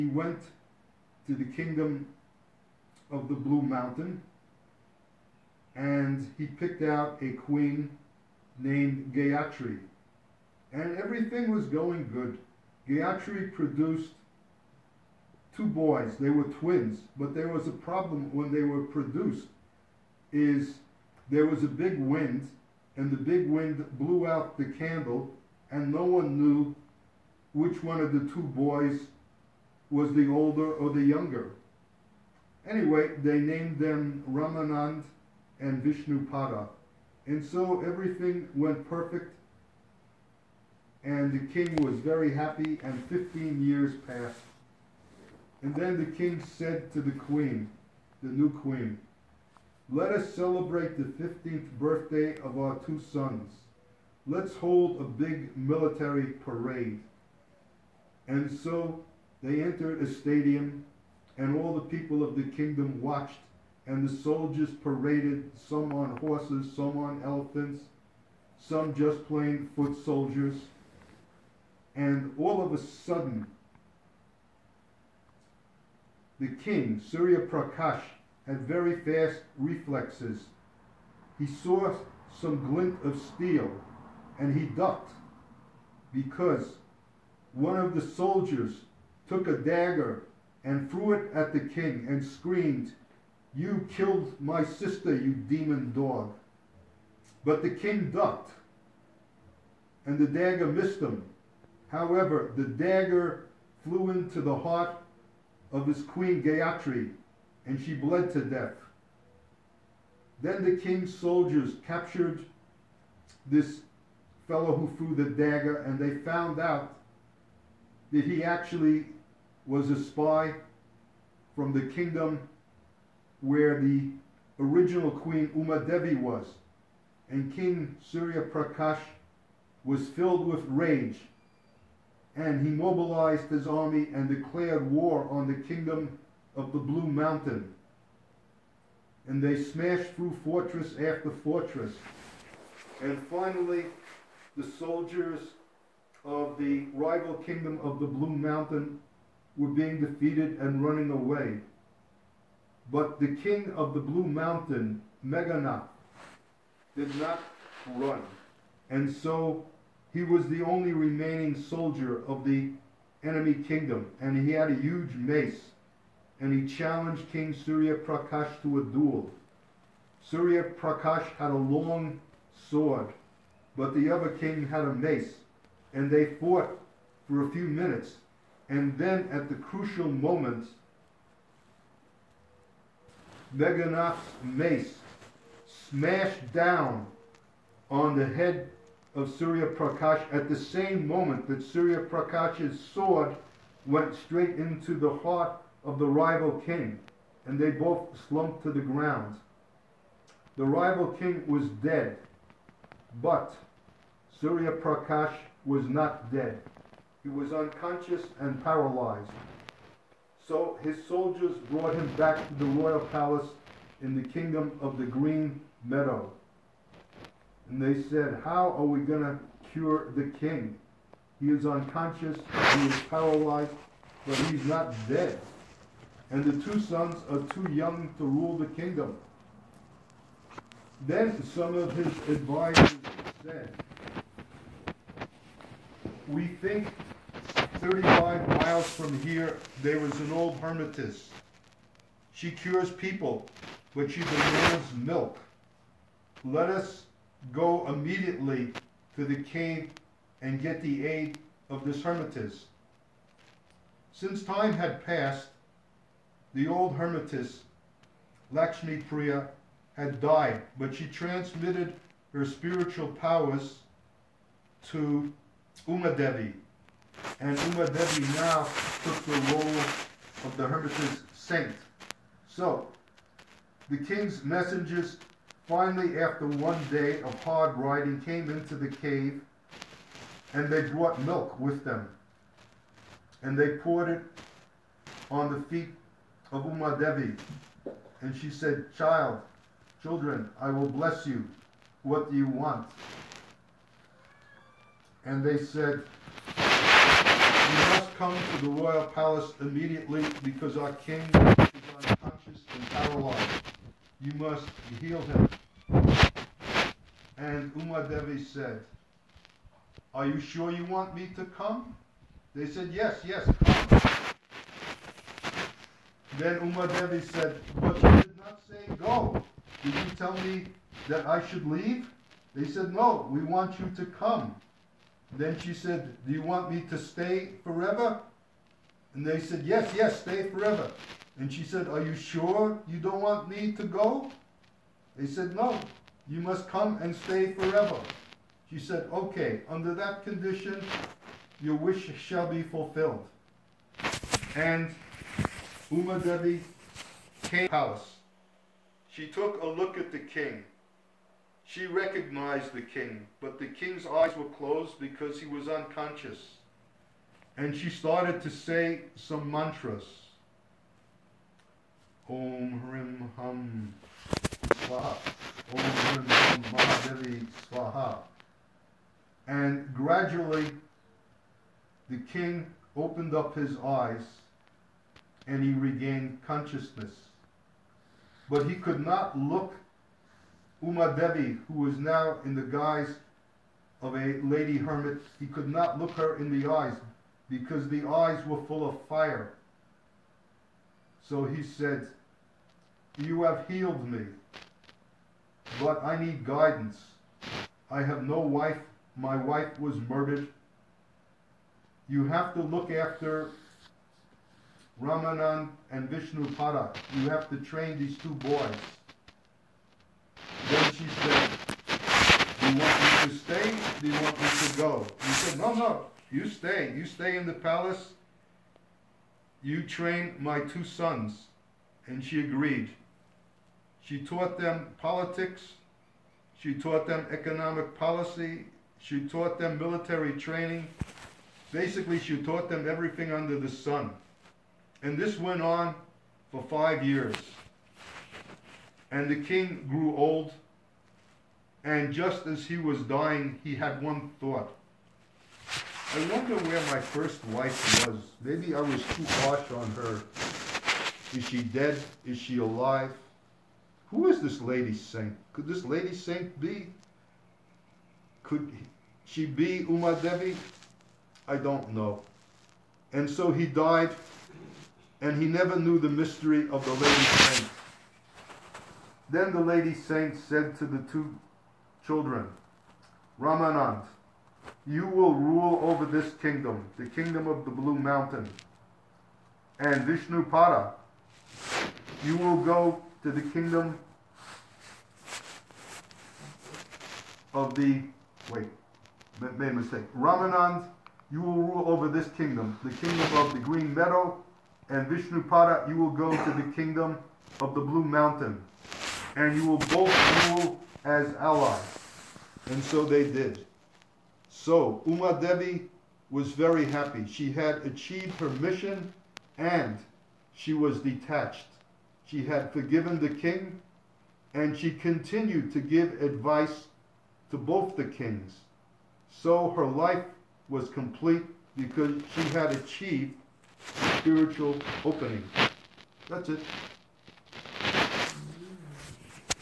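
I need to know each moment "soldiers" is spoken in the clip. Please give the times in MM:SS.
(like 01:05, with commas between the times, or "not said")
01:04, 01:10, 01:28, 01:51, 02:24, 02:41, 03:31.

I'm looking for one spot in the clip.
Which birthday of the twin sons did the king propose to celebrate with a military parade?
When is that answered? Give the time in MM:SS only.
00:51.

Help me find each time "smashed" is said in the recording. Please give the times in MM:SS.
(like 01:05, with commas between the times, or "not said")
02:19, 03:05.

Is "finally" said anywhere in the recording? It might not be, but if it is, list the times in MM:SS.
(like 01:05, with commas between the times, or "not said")
02:23, 04:35.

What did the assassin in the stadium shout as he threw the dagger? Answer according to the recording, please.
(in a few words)
You killed my sister.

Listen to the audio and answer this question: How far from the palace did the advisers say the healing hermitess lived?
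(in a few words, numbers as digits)
35 miles.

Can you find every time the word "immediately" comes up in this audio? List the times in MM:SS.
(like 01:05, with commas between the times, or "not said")
04:07, 04:59.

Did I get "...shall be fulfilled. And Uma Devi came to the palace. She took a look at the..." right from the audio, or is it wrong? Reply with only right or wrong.
right.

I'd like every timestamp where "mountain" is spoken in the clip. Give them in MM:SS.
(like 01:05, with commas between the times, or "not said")
00:03, 02:17, 02:28, 02:34, 07:57, 08:18.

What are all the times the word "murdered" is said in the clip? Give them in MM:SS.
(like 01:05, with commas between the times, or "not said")
06:40.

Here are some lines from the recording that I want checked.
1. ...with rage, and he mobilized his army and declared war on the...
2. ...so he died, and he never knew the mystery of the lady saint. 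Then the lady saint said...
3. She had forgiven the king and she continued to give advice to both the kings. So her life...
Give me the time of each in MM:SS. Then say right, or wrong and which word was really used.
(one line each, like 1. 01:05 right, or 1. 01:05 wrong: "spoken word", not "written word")
1. 02:10 right
2. 07:43 right
3. 08:32 right.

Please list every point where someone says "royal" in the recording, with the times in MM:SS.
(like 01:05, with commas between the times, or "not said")
03:32, 04:58.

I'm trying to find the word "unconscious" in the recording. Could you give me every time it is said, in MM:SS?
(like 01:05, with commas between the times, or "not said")
03:27, 03:41, 05:01, 05:55.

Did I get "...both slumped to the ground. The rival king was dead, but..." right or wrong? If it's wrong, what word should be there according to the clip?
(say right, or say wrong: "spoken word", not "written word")
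right.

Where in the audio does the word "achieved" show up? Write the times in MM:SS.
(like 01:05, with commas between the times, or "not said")
08:27, 08:42.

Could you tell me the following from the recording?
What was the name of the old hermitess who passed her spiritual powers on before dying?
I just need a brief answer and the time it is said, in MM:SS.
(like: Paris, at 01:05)
Lakshmi Priya, at 04:18.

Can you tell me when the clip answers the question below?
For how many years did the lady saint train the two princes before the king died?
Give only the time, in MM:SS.
07:16.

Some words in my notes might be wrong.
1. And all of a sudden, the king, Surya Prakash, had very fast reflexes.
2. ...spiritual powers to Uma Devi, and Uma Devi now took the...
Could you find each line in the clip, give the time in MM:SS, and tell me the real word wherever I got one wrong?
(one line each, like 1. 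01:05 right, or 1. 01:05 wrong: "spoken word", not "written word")
1. 01:11 right
2. 04:22 right.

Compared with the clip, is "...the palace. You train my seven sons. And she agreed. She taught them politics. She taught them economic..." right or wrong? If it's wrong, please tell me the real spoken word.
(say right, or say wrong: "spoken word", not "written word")
wrong: "two", not "seven".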